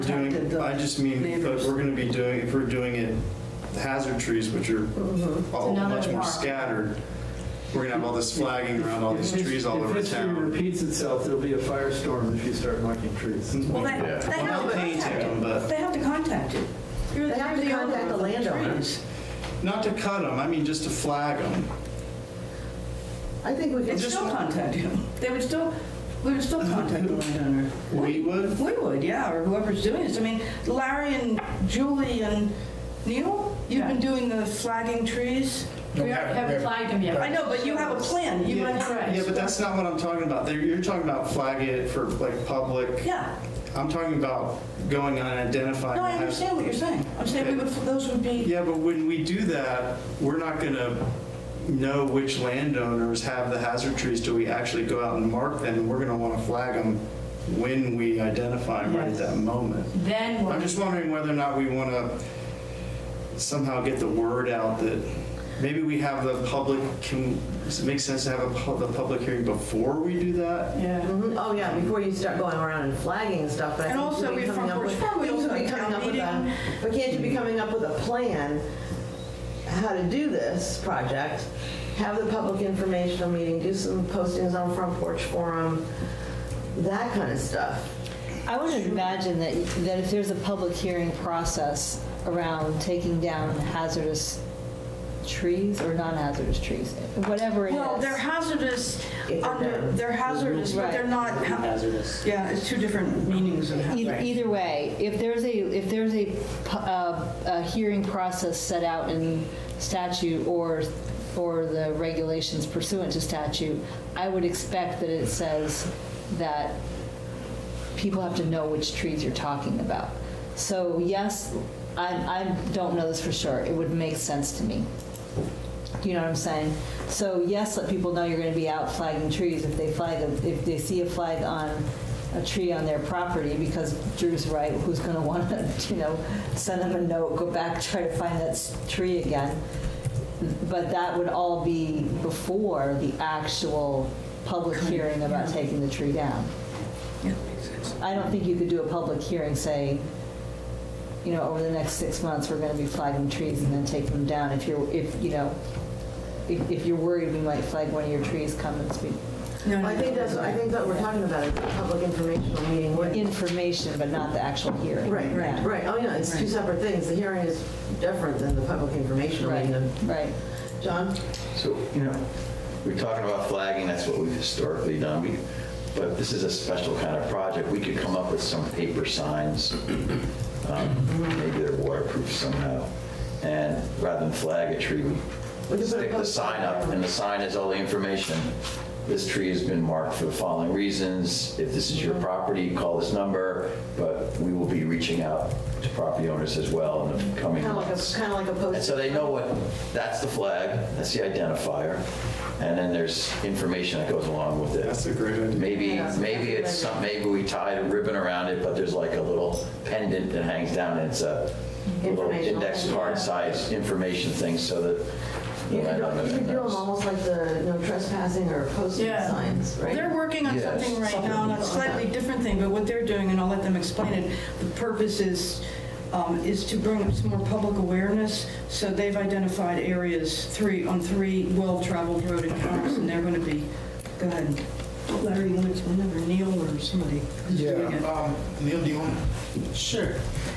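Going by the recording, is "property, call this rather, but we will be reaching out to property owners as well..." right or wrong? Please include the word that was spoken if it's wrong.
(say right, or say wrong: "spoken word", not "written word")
wrong: "number", not "rather".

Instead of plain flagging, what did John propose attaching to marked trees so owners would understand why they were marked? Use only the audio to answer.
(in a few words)
paper signs.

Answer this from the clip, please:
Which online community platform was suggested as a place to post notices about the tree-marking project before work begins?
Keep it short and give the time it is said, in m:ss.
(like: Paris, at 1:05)
Front Porch Forum, at 1:24.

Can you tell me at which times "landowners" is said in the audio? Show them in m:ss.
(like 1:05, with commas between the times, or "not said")
0:18, 0:27, 0:52.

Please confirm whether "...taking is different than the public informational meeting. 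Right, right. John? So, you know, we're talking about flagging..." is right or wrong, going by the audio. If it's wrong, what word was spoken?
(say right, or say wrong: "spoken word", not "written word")
wrong: "hearing", not "taking".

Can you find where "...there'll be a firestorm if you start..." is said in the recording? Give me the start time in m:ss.
0:11.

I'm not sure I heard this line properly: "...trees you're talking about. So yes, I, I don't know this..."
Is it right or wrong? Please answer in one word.
right.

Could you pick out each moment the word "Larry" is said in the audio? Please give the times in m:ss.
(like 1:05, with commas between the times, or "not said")
0:30, 3:55.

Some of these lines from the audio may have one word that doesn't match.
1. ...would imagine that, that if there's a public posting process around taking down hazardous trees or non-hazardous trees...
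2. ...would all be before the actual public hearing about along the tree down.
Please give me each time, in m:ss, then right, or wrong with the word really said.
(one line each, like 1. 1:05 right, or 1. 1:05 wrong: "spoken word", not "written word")
1. 1:28 wrong: "hearing", not "posting"
2. 2:21 wrong: "taking", not "along".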